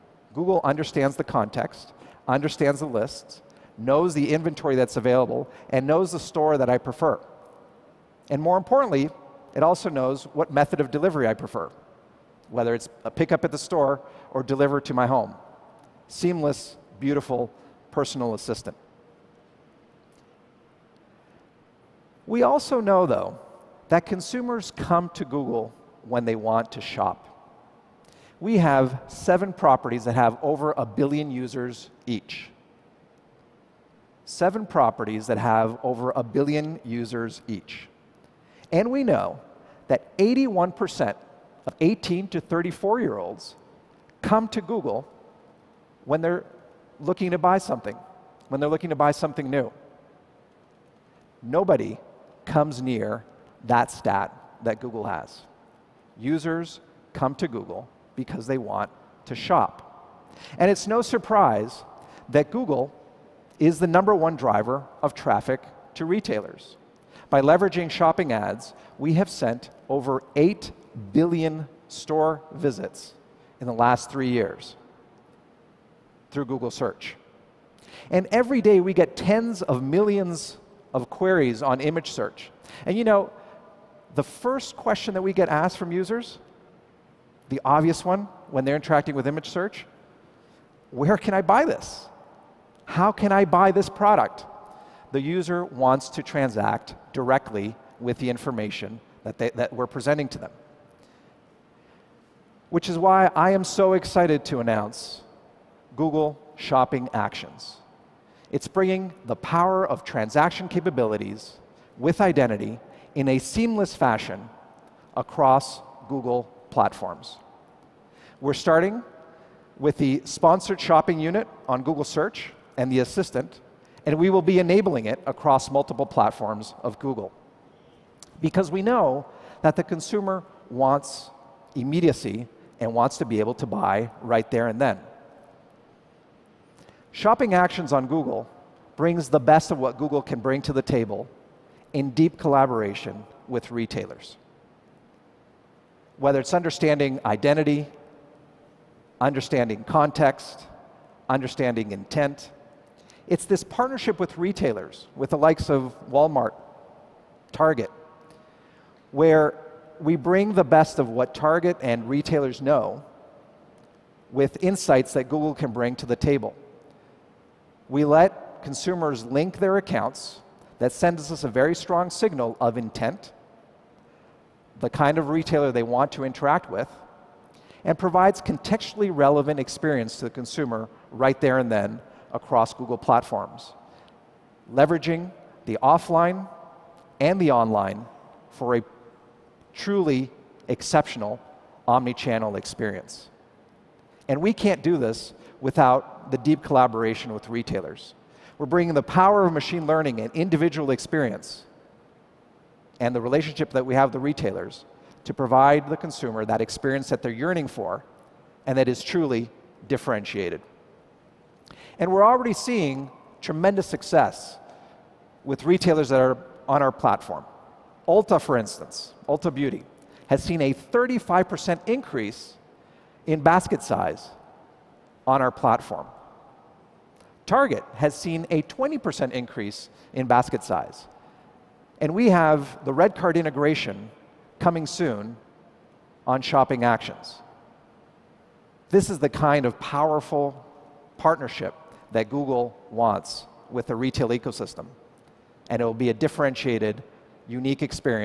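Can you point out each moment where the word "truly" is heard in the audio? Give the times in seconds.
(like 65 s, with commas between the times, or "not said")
189 s, 209 s.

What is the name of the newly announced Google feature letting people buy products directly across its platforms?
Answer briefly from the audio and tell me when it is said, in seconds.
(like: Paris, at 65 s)
Google Shopping Actions, at 105 s.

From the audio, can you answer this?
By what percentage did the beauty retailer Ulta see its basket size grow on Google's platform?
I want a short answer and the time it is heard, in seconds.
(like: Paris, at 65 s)
35%, at 220 s.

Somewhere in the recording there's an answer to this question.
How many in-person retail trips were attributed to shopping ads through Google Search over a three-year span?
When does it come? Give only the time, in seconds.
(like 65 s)
70 s.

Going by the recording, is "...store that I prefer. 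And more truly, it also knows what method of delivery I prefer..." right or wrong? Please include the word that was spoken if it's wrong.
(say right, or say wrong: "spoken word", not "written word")
wrong: "importantly", not "truly".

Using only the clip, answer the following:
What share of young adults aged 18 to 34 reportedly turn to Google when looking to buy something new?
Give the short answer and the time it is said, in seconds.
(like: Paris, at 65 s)
81%, at 40 s.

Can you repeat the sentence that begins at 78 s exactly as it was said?
And every day we get tens of millions of queries on image search.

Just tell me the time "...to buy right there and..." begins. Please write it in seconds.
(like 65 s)
133 s.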